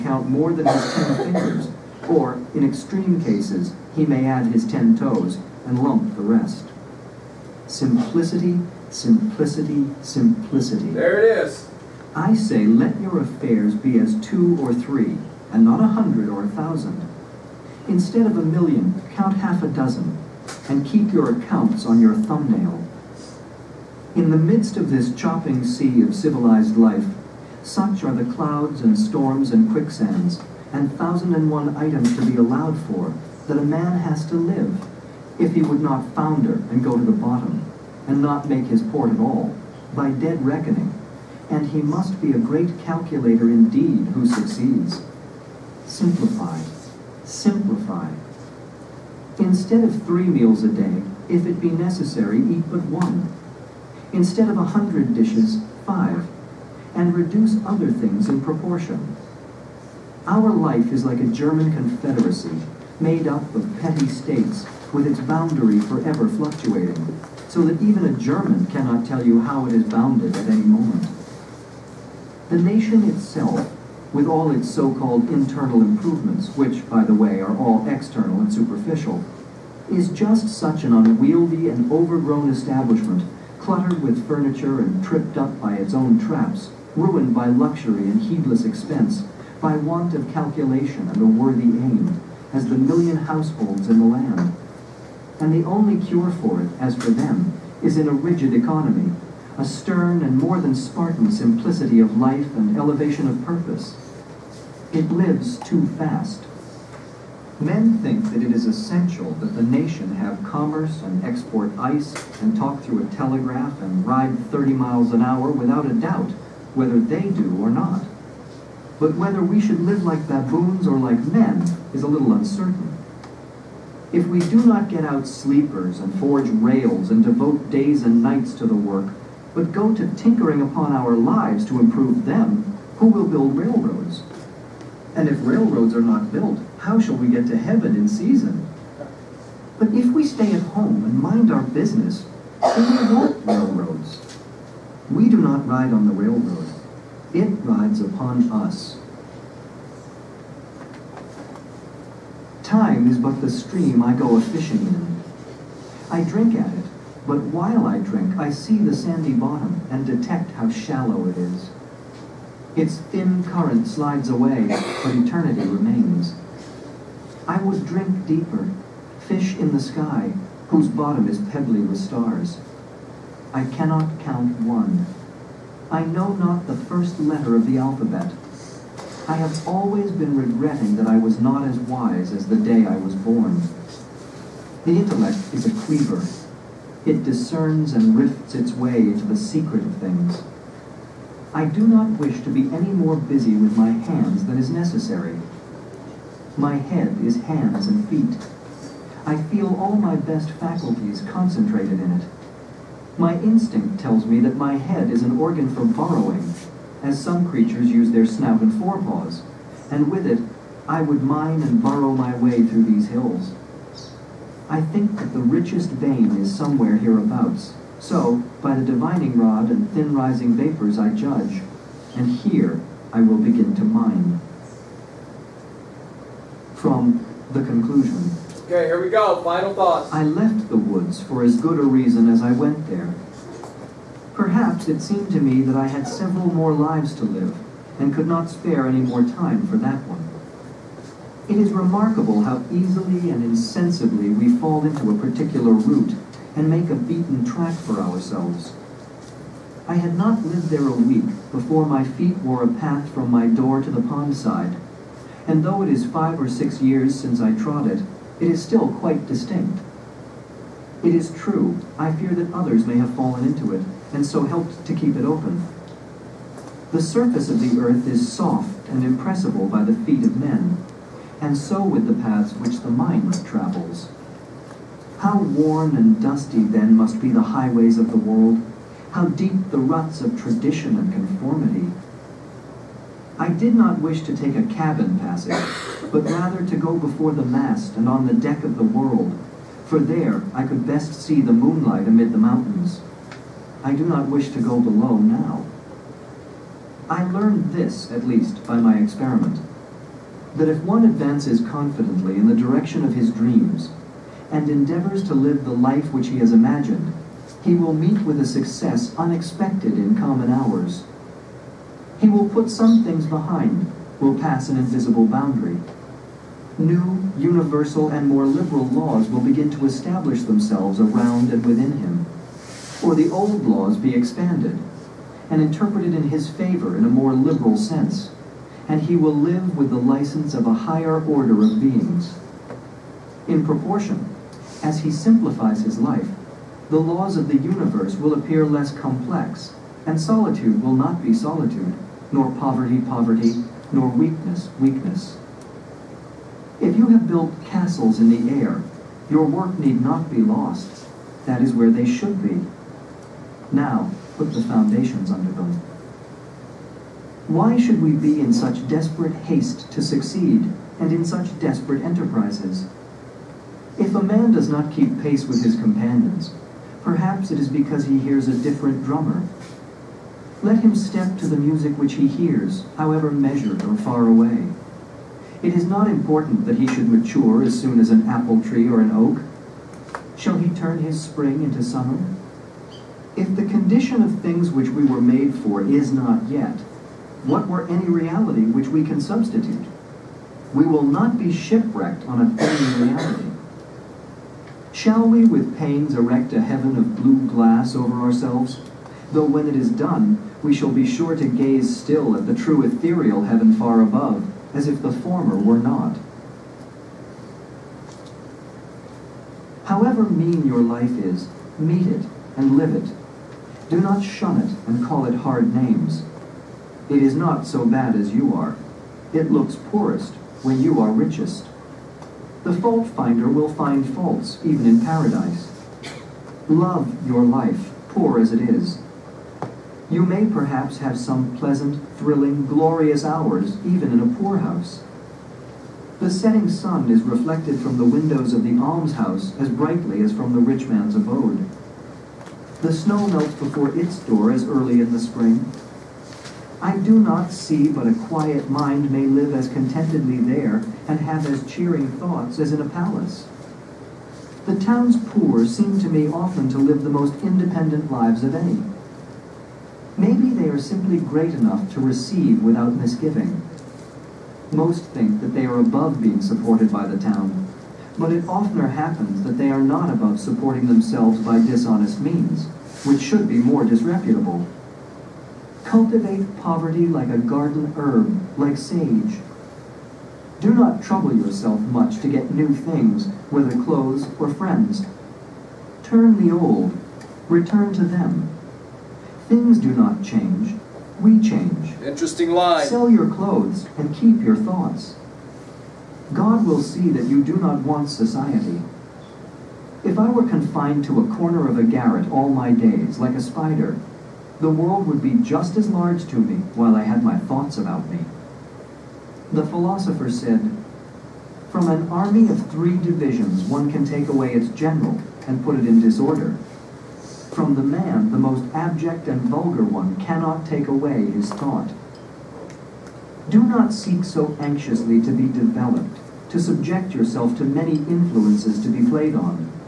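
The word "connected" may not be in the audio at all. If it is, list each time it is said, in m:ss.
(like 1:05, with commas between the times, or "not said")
not said.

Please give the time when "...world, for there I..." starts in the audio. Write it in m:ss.
4:48.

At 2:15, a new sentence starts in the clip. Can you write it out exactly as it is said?
And if railroads are not built, how shall we get to heaven in season?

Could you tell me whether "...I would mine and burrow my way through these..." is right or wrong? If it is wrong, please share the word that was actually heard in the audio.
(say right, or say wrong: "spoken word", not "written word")
right.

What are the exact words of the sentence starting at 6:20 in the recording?
Shall he turn his spring into summer?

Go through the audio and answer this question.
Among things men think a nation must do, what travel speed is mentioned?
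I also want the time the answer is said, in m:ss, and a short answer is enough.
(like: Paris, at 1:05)
30 miles an hour, at 1:54.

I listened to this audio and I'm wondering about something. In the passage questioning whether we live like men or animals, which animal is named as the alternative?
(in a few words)
Baboons.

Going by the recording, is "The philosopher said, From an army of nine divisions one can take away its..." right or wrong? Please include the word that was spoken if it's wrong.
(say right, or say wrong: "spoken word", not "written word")
wrong: "three", not "nine".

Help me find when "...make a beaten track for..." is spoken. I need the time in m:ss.
4:06.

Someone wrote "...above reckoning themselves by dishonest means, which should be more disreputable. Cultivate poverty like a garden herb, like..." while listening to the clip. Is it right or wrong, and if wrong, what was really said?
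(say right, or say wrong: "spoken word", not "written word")
wrong: "supporting", not "reckoning".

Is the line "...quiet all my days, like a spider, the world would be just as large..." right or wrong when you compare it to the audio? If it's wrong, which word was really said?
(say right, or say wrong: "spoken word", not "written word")
wrong: "garret", not "quiet".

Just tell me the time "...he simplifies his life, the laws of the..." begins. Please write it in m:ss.
5:34.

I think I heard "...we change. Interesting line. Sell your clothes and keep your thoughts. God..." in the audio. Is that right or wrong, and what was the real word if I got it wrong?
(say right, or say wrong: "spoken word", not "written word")
right.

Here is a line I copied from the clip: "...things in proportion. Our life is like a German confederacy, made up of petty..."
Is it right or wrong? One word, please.
right.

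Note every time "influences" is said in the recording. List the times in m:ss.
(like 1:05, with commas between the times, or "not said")
8:47.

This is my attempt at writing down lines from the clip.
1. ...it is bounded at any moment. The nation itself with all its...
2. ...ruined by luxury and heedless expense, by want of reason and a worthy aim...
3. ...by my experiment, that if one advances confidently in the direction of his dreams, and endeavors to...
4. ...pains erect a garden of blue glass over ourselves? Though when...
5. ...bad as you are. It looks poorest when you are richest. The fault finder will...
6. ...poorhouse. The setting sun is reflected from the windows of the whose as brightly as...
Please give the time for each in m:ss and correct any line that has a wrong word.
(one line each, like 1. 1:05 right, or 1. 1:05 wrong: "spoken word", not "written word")
1. 1:09 right
2. 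1:26 wrong: "calculation", not "reason"
3. 4:58 right
4. 6:35 wrong: "heaven", not "garden"
5. 6:57 right
6. 7:14 wrong: "almshouse", not "whose".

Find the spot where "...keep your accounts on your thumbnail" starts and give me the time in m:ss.
0:20.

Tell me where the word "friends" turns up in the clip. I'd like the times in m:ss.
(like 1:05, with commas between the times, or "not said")
8:04.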